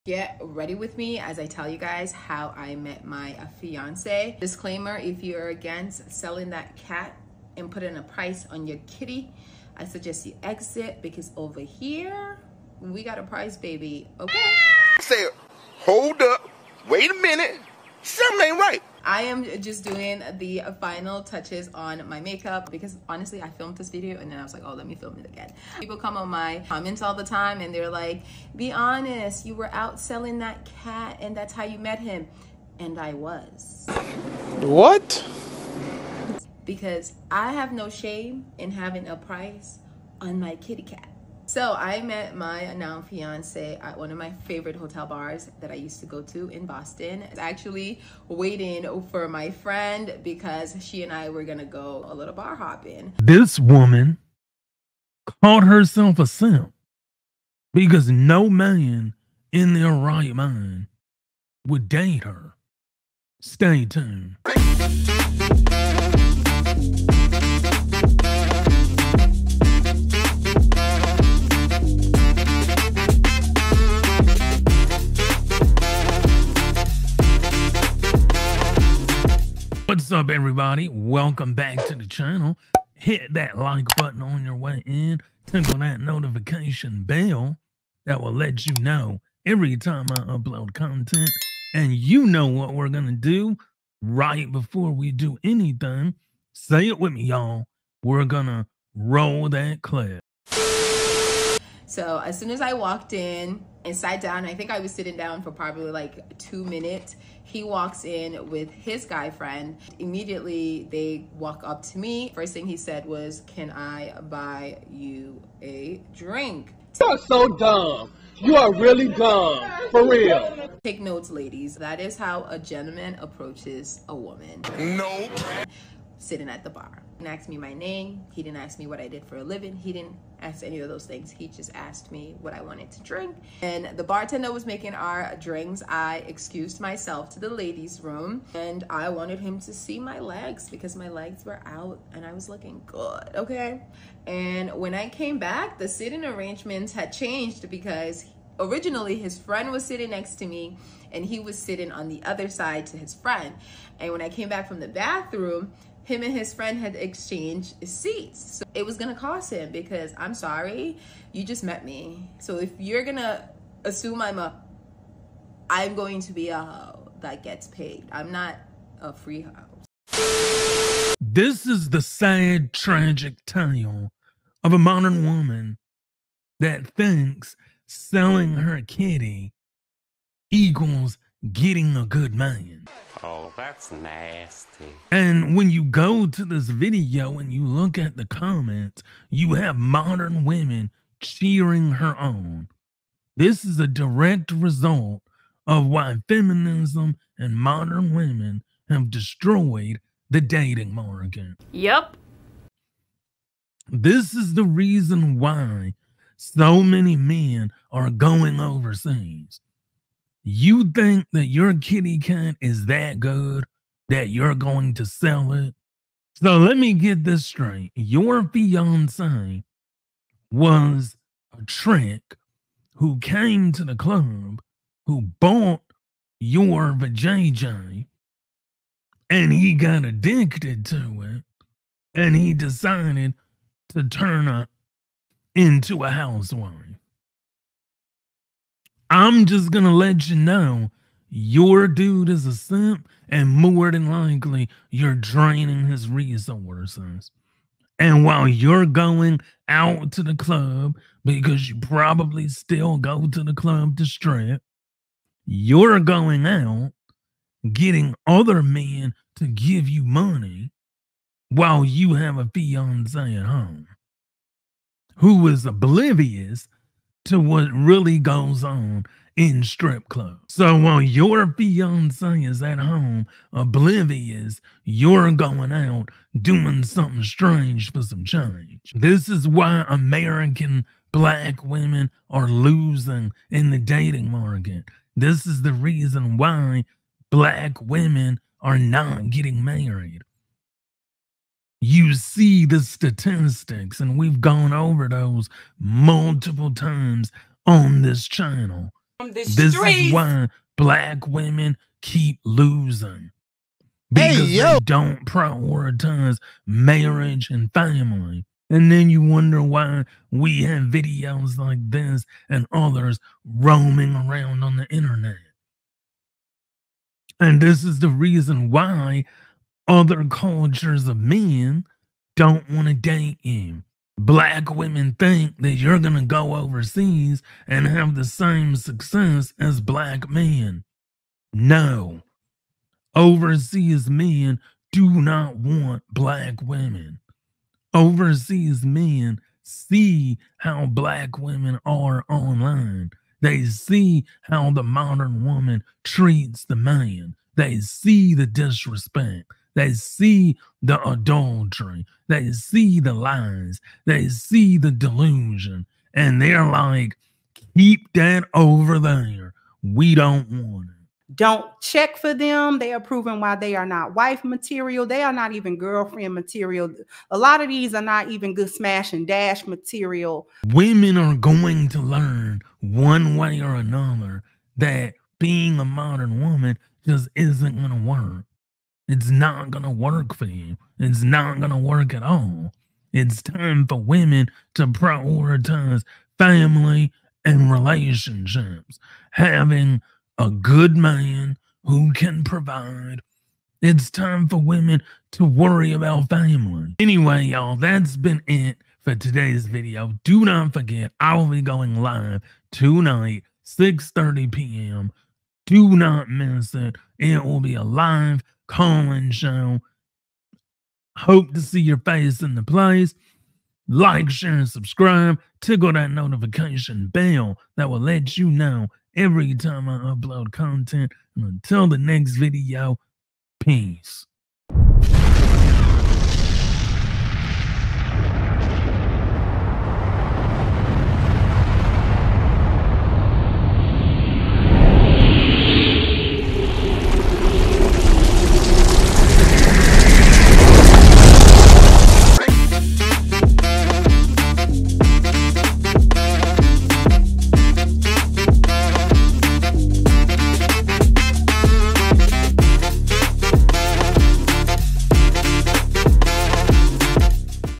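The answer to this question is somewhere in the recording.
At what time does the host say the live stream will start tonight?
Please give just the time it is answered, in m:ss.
6:43.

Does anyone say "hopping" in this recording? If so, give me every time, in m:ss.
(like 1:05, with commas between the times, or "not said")
0:52.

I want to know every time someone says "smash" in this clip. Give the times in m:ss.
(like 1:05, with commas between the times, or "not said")
6:08.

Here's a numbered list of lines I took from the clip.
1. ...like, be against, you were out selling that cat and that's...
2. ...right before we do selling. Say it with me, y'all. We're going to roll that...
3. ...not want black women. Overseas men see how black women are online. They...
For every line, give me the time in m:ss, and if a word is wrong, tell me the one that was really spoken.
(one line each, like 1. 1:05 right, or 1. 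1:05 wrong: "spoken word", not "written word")
1. 0:27 wrong: "honest", not "against"
2. 1:34 wrong: "anything", not "selling"
3. 5:35 right.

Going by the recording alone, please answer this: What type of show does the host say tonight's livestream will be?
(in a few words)
live Calling Show.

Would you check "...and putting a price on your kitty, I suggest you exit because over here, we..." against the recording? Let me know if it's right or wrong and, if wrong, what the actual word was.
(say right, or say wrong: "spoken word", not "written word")
right.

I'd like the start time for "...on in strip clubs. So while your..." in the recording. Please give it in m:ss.
4:28.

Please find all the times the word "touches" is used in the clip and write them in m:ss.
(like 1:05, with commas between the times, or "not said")
0:21.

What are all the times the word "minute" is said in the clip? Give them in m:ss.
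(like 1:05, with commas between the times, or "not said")
0:17, 1:46.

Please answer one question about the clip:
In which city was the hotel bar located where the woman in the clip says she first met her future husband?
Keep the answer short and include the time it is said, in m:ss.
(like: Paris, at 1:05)
Boston, at 0:46.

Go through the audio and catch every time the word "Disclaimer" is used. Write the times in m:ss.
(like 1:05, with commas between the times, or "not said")
0:04.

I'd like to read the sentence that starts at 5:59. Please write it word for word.
We don't want it don't check for them.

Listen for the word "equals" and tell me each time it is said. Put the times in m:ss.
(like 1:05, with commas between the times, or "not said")
3:00.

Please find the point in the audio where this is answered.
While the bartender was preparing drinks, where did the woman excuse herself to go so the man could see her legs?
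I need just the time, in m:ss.
2:17.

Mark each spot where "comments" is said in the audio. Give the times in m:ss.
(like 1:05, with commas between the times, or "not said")
0:26, 3:08.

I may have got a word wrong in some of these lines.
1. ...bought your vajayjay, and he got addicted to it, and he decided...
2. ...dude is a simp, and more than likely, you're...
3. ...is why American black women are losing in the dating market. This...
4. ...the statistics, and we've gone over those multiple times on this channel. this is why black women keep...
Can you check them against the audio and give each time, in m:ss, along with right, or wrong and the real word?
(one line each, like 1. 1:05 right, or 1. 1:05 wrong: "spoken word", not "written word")
1. 3:45 right
2. 4:01 right
3. 4:39 right
4. 4:52 right.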